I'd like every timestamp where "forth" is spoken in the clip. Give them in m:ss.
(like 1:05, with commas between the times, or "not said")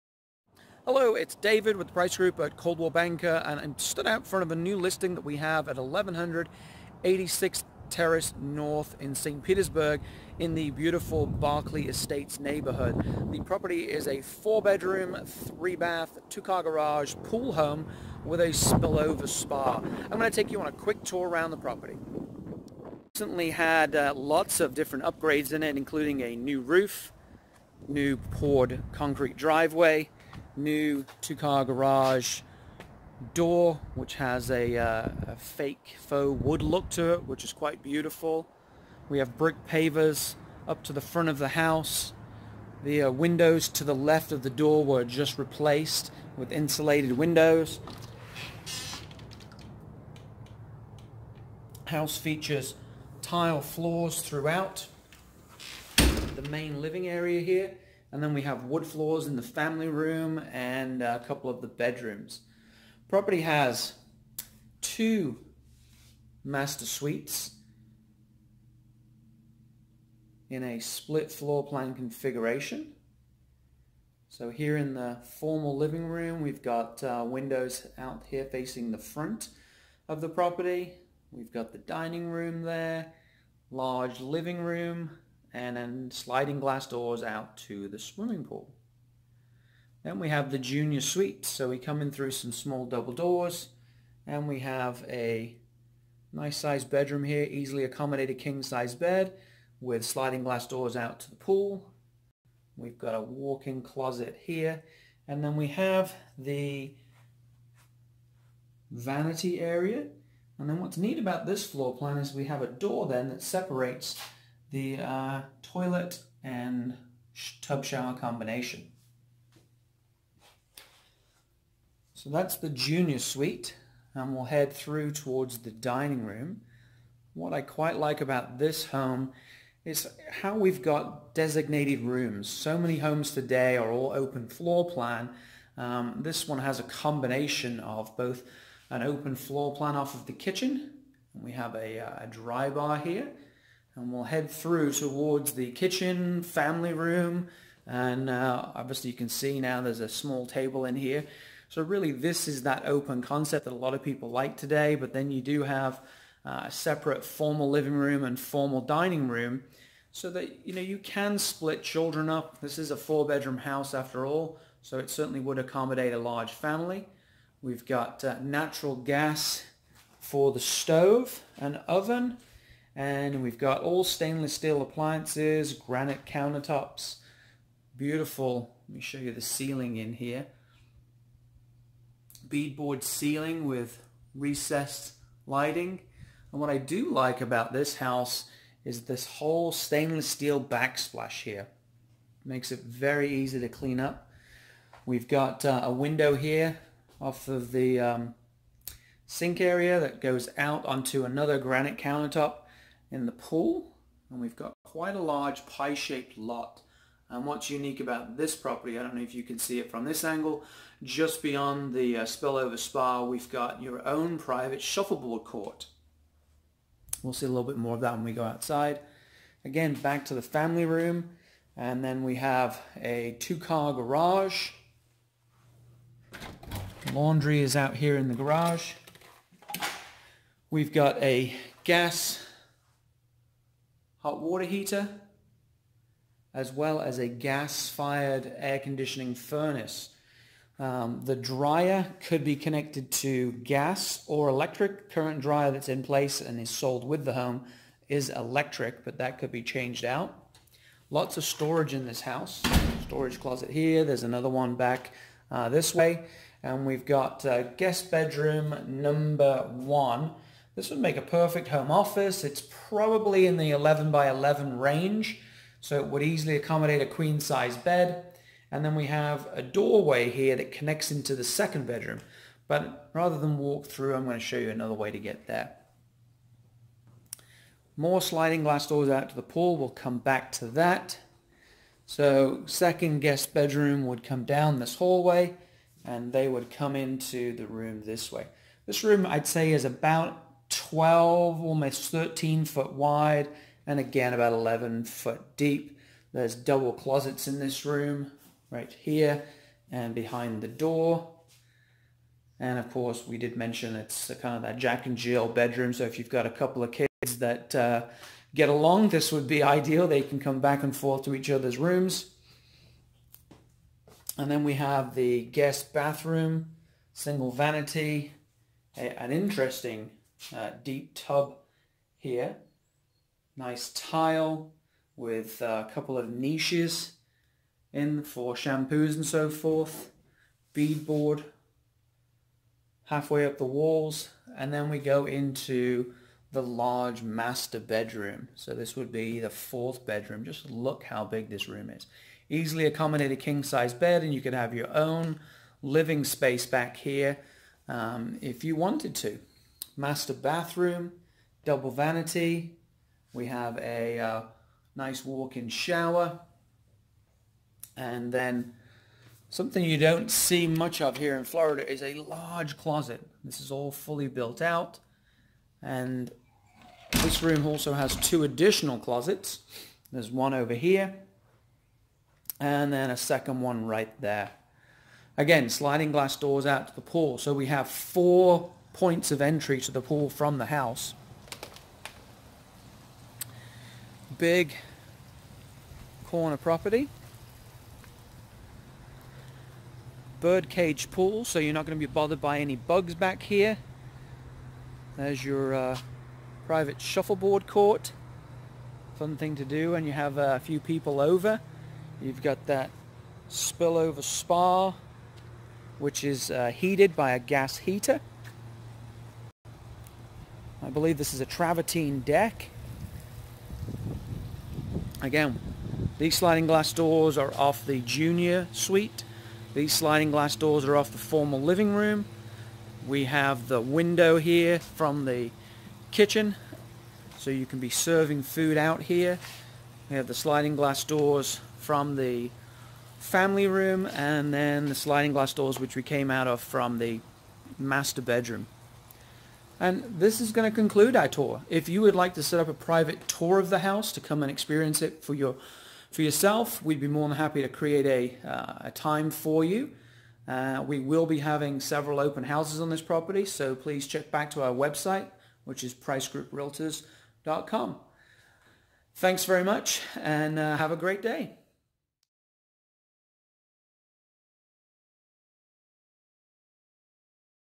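5:10, 5:29.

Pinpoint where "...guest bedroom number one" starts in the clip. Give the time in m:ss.
4:17.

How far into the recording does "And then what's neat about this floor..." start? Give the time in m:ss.
1:50.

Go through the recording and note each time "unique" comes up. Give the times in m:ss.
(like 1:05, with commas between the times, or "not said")
3:27.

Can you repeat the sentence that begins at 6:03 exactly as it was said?
This is all fully built out.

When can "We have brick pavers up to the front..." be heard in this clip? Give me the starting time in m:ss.
0:39.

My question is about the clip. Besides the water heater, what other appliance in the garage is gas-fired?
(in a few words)
air conditioning furnace.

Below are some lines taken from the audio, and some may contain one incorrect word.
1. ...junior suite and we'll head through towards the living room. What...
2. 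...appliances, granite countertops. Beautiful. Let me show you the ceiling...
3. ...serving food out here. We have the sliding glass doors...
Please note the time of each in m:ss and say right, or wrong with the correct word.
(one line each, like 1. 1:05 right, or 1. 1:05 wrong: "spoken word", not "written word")
1. 2:02 wrong: "dining", not "living"
2. 2:54 right
3. 7:07 right.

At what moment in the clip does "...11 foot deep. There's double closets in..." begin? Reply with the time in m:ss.
4:54.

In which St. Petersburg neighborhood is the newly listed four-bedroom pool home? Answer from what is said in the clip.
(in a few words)
Barclay Estates.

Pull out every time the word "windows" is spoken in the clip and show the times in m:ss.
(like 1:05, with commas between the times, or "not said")
0:43, 0:47, 1:17, 3:15, 7:03.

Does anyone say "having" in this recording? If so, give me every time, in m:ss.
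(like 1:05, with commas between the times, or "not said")
7:31.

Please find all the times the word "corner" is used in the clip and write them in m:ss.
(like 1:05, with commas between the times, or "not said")
6:26.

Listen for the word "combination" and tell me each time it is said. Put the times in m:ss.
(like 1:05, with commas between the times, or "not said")
1:58, 2:16.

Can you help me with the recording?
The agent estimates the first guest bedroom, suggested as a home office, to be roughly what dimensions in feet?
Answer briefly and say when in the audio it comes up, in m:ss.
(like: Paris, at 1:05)
11 by 11, at 4:23.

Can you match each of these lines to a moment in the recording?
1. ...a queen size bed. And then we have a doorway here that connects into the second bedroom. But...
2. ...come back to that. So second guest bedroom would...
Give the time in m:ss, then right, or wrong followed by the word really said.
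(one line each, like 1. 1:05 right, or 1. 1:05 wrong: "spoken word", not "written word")
1. 4:27 right
2. 4:39 right.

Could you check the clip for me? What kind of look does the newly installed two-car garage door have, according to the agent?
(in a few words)
faux wood.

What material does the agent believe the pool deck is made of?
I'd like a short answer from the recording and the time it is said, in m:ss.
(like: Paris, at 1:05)
travertine, at 6:51.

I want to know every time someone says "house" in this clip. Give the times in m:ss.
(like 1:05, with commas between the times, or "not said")
0:41, 0:51, 2:43, 3:07, 4:12, 6:20, 7:23, 7:32.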